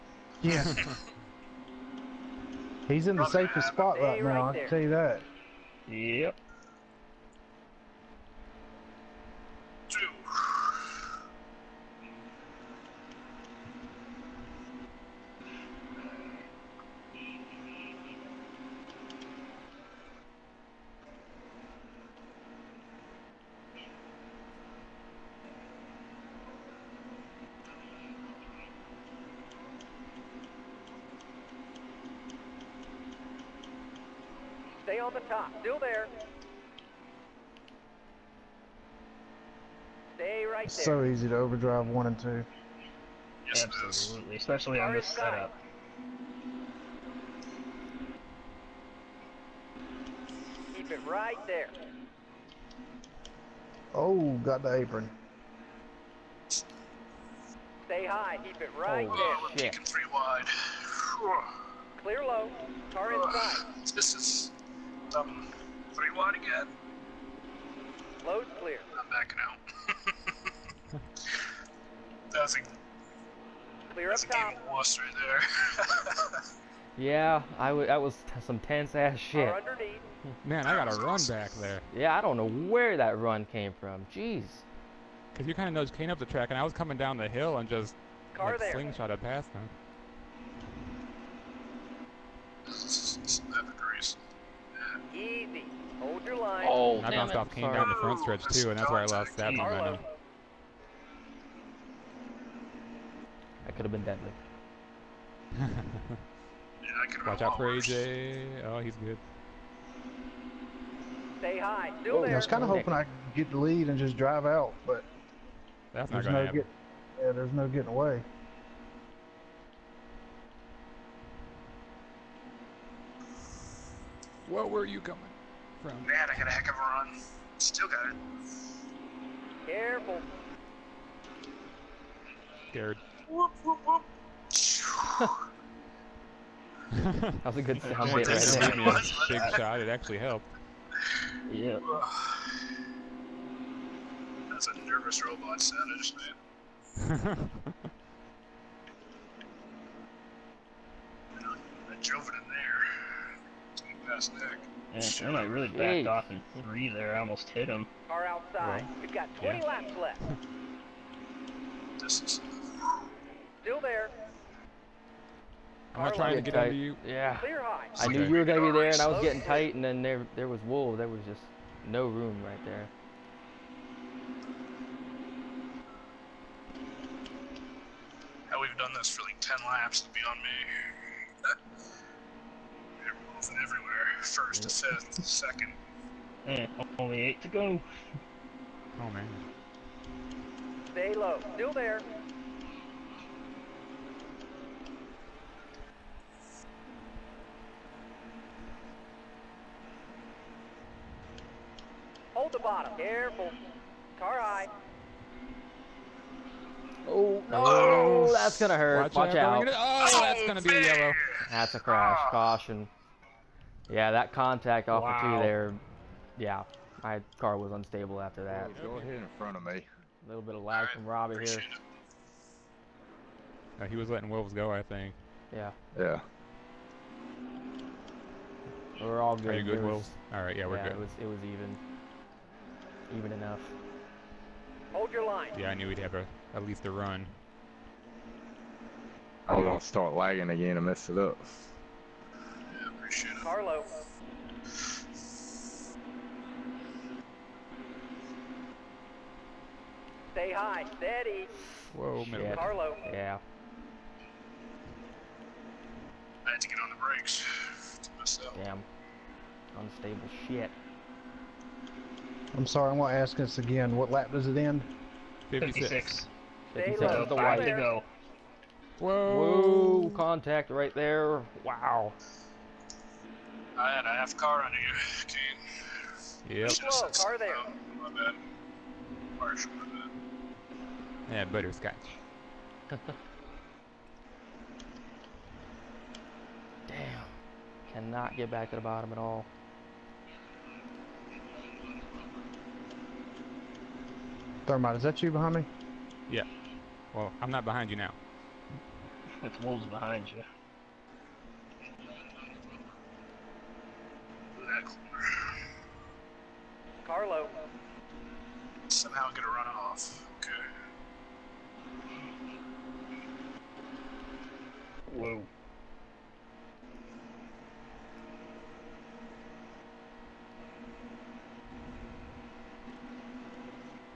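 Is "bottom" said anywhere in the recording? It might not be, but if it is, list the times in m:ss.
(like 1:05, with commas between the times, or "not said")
3:22, 4:48.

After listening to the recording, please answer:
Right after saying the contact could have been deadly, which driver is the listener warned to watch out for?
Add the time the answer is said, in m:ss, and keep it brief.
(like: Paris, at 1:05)
AJ, at 1:47.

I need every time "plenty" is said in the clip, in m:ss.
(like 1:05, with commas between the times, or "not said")
not said.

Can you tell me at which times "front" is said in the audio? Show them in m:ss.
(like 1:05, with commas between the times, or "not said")
1:37, 3:39.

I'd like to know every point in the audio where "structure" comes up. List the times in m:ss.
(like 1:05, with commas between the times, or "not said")
not said.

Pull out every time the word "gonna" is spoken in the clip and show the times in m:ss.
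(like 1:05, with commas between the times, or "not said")
2:48, 5:09.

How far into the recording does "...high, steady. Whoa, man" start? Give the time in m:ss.
4:10.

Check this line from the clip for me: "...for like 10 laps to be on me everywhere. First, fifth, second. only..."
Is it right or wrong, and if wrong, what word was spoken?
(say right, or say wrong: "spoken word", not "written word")
right.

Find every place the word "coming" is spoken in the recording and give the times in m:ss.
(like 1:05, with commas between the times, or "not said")
1:26, 2:05.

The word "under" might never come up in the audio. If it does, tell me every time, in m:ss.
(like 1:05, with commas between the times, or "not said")
2:46, 4:34.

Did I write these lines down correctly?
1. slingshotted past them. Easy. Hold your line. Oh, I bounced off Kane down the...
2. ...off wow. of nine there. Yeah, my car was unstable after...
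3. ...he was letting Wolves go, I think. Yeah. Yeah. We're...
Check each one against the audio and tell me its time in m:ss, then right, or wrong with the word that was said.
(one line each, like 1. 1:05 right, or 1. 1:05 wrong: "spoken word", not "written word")
1. 1:28 right
2. 3:34 wrong: "two", not "nine"
3. 3:43 right.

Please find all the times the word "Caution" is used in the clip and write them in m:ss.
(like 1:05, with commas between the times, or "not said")
3:32.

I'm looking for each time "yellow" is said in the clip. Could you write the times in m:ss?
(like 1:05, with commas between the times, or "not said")
3:30.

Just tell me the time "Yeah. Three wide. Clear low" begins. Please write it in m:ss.
0:59.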